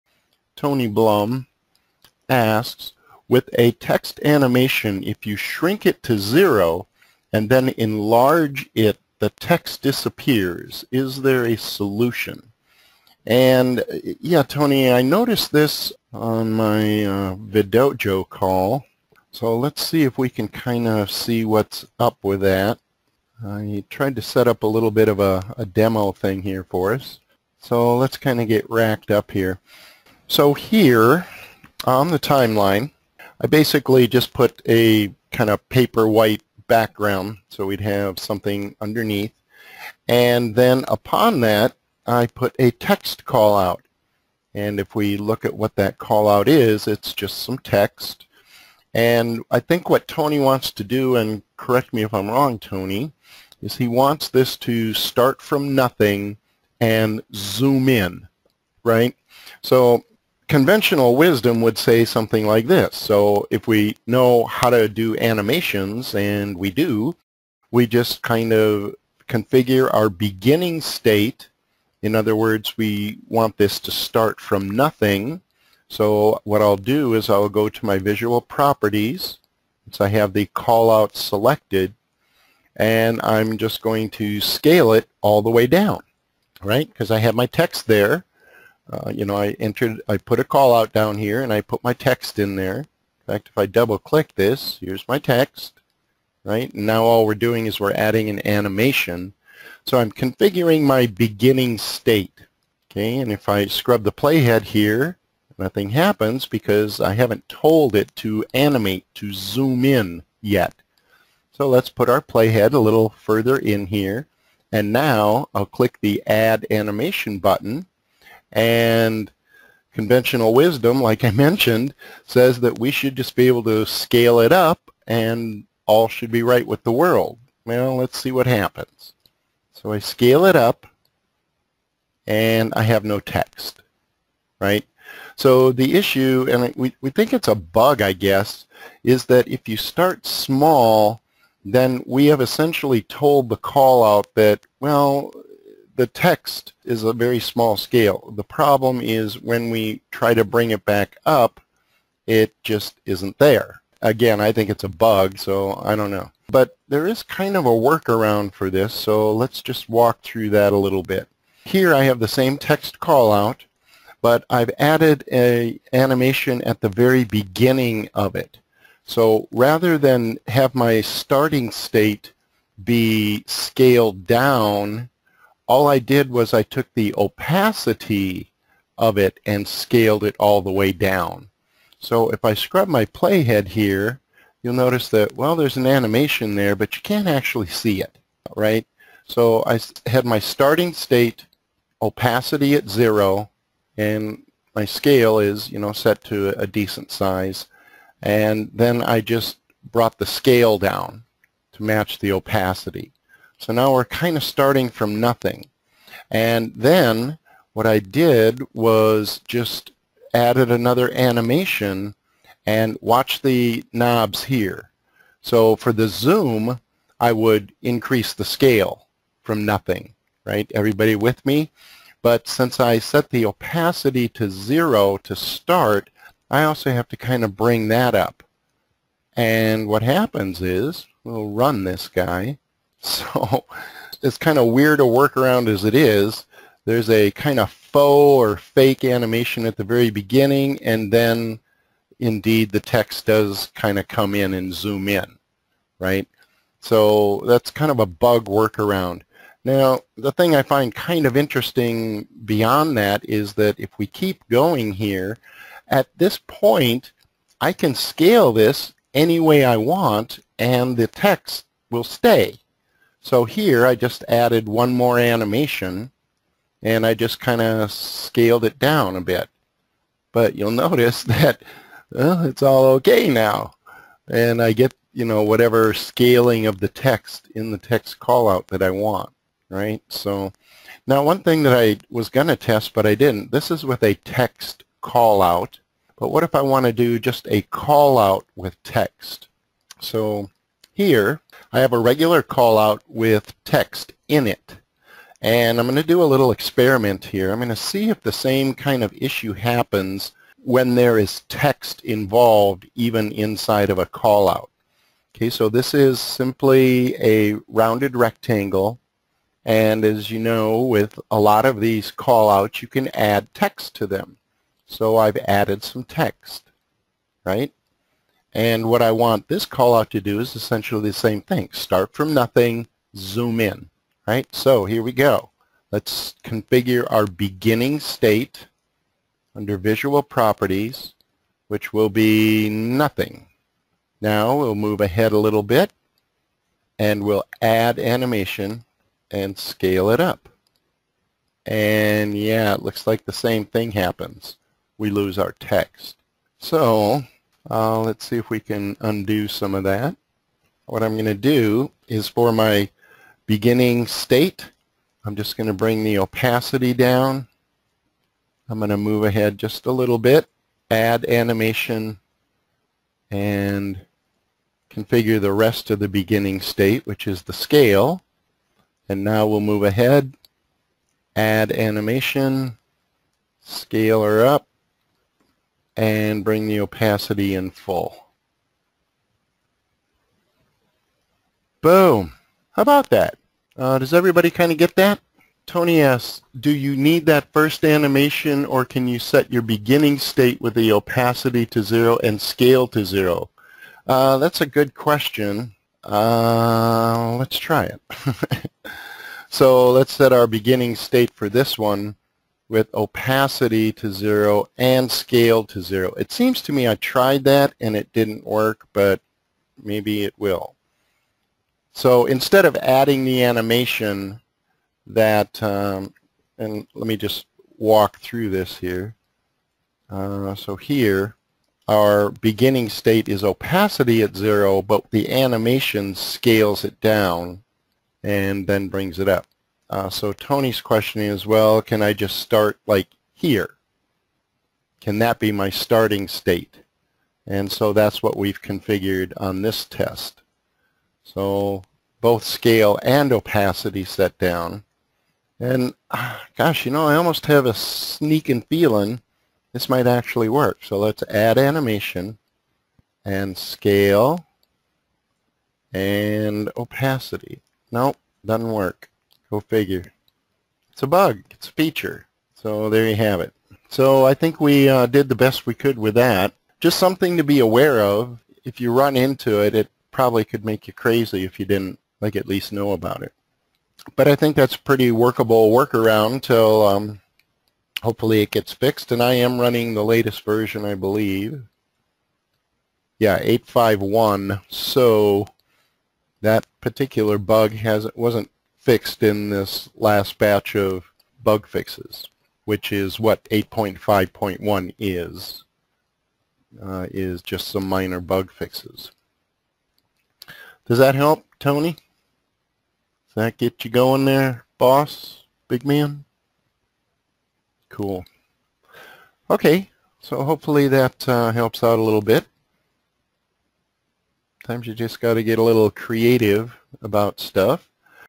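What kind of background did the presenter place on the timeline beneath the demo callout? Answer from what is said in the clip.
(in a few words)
paper white.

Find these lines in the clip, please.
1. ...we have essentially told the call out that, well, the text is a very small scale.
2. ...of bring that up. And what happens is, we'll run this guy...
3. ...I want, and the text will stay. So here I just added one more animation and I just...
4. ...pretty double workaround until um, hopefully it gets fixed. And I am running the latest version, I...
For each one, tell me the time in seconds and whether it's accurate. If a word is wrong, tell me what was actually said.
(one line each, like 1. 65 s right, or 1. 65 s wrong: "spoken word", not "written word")
1. 142 s right
2. 227 s right
3. 259 s right
4. 474 s wrong: "workable", not "double".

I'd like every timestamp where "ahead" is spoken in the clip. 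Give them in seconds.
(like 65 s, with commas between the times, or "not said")
335 s, 359 s, 369 s.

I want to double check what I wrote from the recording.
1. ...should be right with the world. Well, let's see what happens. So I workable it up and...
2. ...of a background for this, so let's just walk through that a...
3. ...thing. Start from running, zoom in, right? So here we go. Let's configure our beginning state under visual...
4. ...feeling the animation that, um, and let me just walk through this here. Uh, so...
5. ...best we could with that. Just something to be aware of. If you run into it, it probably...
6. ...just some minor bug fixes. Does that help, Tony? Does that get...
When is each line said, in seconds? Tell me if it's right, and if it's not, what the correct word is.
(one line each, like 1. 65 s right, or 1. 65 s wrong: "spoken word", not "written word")
1. 126 s wrong: "scale", not "workable"
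2. 157 s wrong: "workaround", not "background"
3. 321 s wrong: "nothing", not "running"
4. 412 s wrong: "adding", not "feeling"
5. 465 s right
6. 497 s right.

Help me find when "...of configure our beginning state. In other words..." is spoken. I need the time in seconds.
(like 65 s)
68 s.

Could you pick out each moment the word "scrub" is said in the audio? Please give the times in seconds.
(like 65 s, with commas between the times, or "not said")
103 s, 182 s.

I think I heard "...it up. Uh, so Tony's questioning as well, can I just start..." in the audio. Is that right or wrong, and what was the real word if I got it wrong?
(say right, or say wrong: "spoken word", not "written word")
right.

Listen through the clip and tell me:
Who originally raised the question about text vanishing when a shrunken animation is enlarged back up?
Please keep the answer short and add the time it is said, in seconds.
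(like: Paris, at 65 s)
Tony Blum, at 0 s.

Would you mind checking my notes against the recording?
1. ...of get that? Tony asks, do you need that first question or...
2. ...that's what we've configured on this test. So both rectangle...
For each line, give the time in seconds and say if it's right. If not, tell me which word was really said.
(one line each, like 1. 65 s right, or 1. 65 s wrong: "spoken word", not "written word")
1. 384 s wrong: "animation", not "question"
2. 437 s wrong: "scale", not "rectangle".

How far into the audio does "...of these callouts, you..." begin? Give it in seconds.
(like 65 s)
311 s.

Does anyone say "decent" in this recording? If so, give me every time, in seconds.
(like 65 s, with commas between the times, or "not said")
196 s.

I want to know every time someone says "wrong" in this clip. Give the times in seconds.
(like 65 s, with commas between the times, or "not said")
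52 s.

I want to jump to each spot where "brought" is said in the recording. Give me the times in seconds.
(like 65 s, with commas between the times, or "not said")
199 s.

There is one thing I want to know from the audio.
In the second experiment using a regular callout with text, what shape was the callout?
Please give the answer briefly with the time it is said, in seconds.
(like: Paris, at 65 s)
rounded rectangle, at 307 s.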